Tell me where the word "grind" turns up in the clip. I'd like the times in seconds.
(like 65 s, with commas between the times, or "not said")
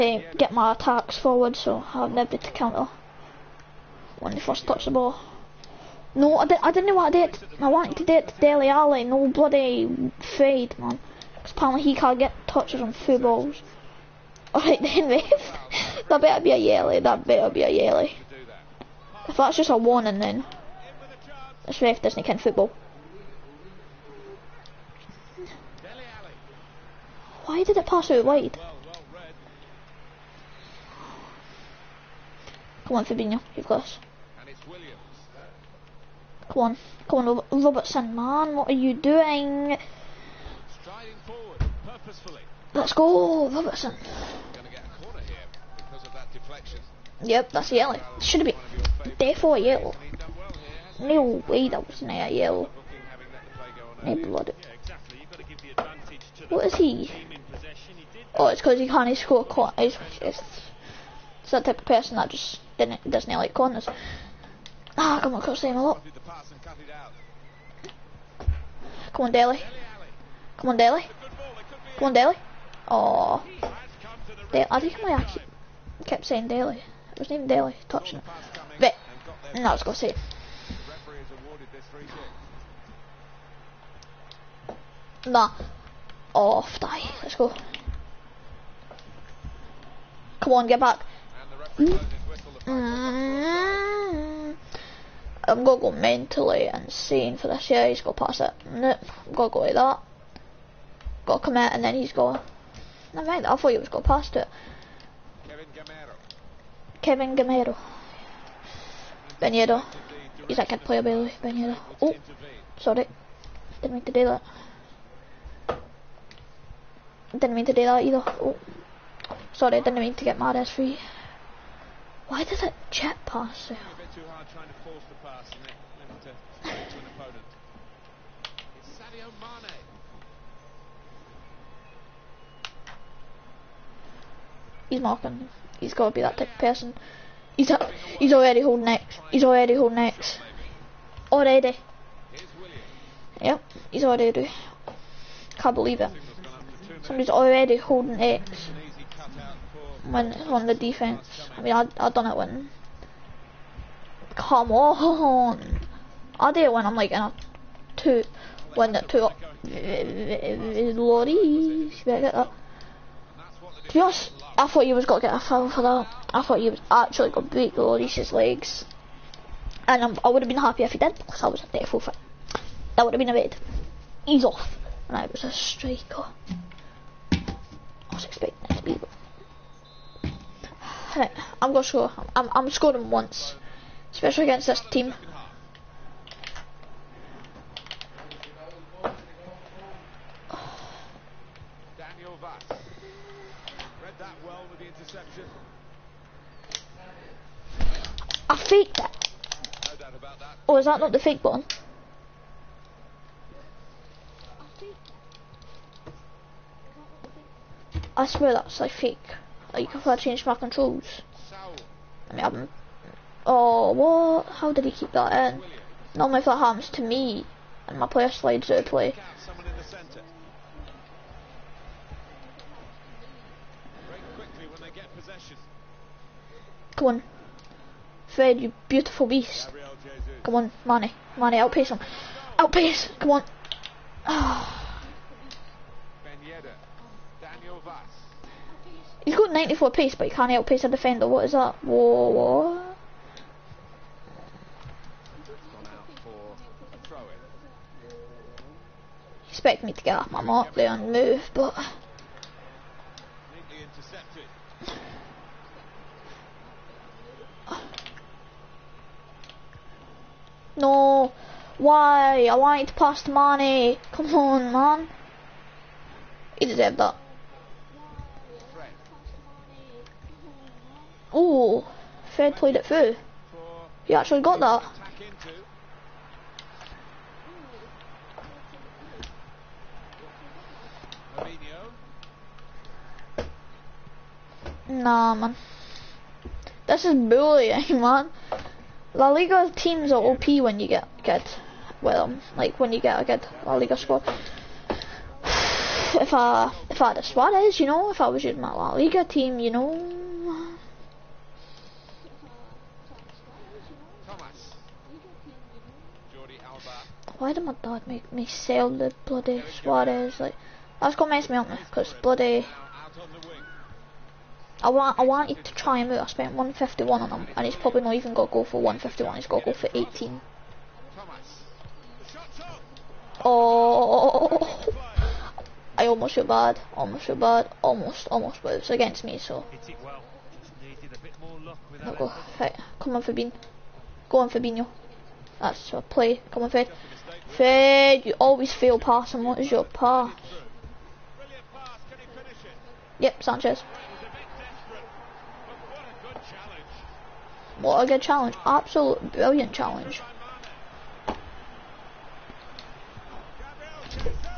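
not said.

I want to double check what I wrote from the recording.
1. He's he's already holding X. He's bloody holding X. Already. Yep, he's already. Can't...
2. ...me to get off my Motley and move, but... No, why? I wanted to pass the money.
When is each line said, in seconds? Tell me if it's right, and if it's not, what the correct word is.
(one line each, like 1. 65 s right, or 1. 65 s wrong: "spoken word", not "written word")
1. 137 s wrong: "already", not "bloody"
2. 249 s right.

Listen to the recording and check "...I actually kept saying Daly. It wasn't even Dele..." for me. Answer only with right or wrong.
wrong.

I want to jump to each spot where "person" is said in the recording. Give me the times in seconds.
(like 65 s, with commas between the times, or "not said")
61 s, 136 s.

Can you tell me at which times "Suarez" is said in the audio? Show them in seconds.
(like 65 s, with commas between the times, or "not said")
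297 s, 309 s.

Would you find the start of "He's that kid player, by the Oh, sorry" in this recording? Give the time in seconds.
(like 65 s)
110 s.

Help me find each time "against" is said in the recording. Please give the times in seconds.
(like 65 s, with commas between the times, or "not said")
184 s, 328 s.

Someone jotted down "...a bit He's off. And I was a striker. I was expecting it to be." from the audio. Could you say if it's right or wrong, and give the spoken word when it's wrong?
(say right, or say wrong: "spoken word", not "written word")
right.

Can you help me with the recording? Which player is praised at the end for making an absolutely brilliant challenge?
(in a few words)
Sanchez.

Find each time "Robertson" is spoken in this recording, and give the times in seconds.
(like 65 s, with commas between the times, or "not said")
37 s, 43 s.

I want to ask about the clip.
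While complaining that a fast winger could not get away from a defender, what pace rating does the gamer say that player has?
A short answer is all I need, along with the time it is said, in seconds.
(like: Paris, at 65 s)
94, at 239 s.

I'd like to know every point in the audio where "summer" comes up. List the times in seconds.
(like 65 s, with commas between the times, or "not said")
not said.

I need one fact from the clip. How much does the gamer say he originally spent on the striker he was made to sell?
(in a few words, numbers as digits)
151.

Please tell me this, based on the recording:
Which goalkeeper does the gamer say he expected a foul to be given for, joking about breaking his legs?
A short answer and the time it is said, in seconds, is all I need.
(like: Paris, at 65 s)
Lloris, at 167 s.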